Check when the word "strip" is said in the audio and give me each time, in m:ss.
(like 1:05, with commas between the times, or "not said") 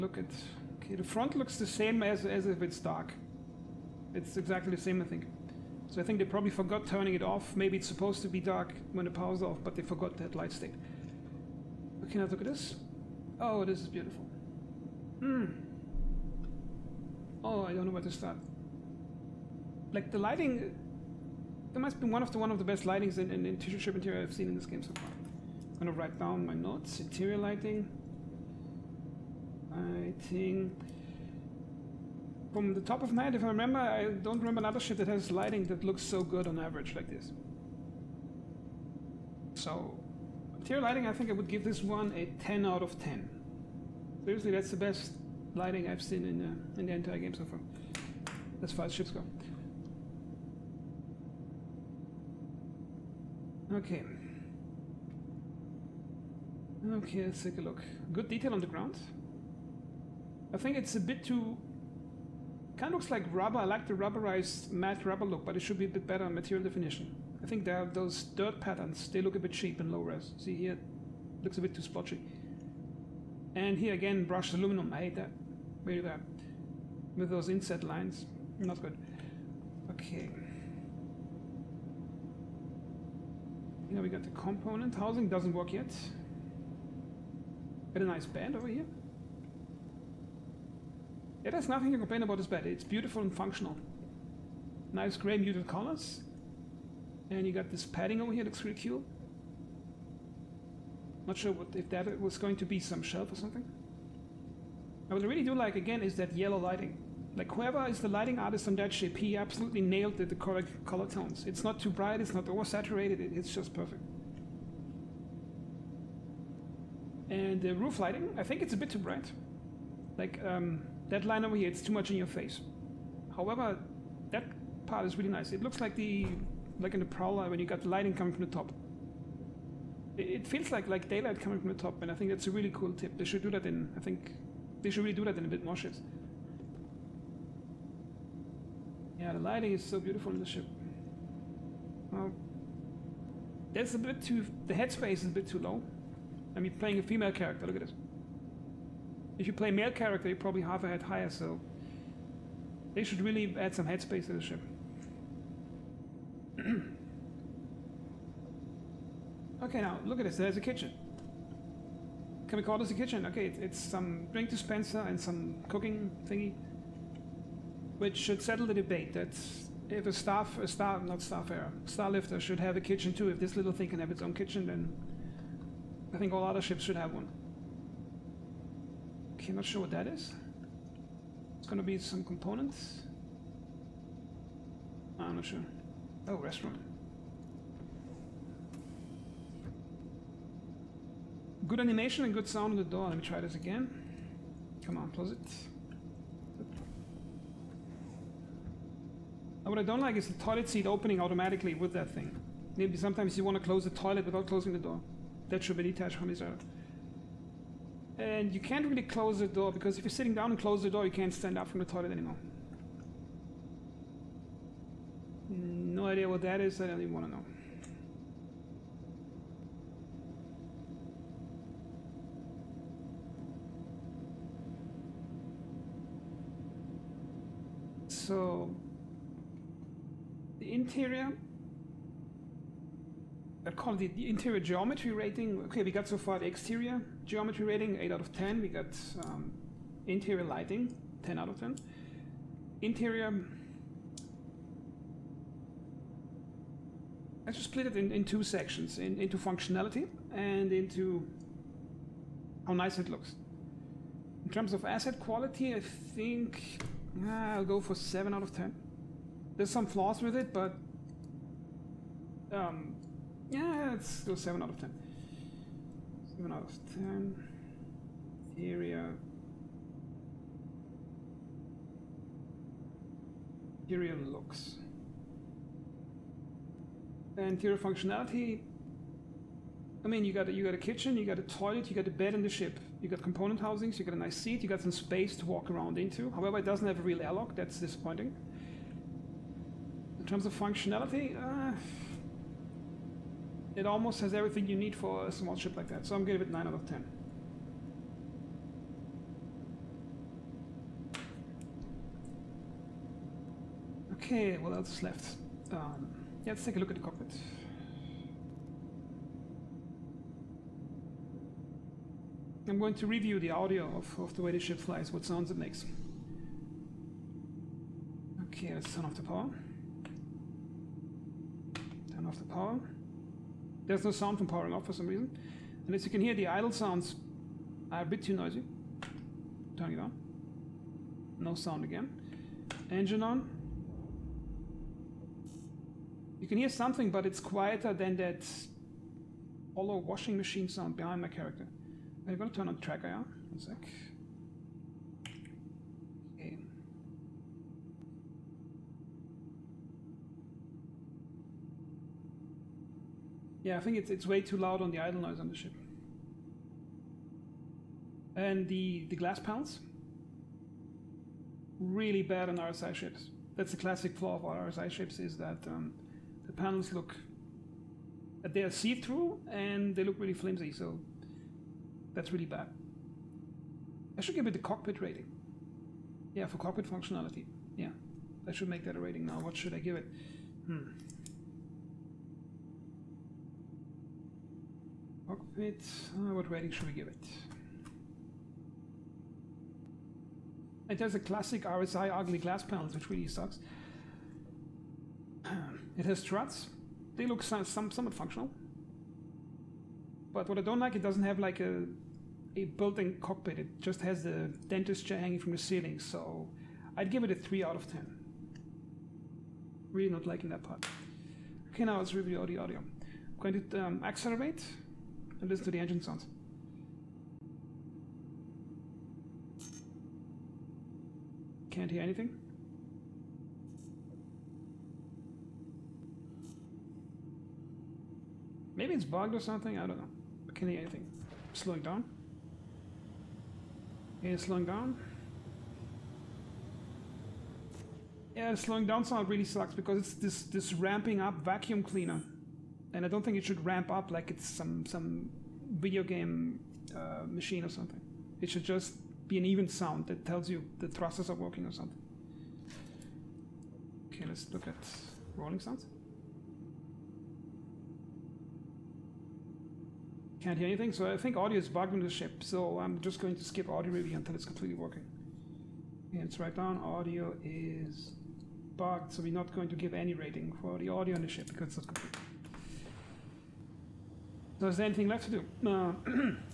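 0:23.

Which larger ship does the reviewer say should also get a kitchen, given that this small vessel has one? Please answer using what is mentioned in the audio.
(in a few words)
Starlifter.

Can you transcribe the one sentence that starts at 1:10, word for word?
See here, looks a bit too splotchy.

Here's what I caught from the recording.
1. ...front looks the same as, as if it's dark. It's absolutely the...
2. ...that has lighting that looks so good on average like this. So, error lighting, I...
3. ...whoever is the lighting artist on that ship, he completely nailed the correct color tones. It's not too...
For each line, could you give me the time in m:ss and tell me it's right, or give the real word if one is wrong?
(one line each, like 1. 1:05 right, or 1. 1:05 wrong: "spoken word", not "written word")
1. 0:01 wrong: "exactly", not "absolutely"
2. 0:34 wrong: "interior", not "error"
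3. 1:47 wrong: "absolutely", not "completely".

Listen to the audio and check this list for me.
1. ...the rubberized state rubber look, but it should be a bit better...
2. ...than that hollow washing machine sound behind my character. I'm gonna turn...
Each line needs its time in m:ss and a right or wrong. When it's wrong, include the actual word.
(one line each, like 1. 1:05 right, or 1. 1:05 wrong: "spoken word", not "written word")
1. 1:03 wrong: "matte", not "state"
2. 5:37 right.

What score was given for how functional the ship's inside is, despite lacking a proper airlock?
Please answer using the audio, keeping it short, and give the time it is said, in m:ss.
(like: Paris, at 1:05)
9 out of 10, at 4:56.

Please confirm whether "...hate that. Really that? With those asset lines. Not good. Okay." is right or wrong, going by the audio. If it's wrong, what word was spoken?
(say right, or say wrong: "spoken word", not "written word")
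wrong: "inset", not "asset".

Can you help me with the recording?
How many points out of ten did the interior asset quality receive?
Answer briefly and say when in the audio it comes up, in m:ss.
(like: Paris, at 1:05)
7, at 4:17.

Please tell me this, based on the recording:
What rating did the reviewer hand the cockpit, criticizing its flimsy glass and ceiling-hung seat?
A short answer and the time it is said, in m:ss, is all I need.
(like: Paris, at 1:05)
3 out of 10, at 6:47.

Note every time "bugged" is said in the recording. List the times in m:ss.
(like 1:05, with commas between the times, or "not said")
7:09, 7:41, 7:48.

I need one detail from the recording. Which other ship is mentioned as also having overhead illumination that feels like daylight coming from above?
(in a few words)
Prowler.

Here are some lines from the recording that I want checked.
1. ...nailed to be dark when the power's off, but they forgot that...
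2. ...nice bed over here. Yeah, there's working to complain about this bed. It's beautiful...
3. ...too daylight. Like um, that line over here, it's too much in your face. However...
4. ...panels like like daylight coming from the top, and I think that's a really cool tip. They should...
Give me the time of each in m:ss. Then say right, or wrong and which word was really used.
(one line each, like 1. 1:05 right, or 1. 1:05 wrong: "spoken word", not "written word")
1. 0:07 wrong: "supposed", not "nailed"
2. 1:28 wrong: "nothing", not "working"
3. 1:58 wrong: "bright", not "daylight"
4. 2:10 wrong: "feels", not "panels".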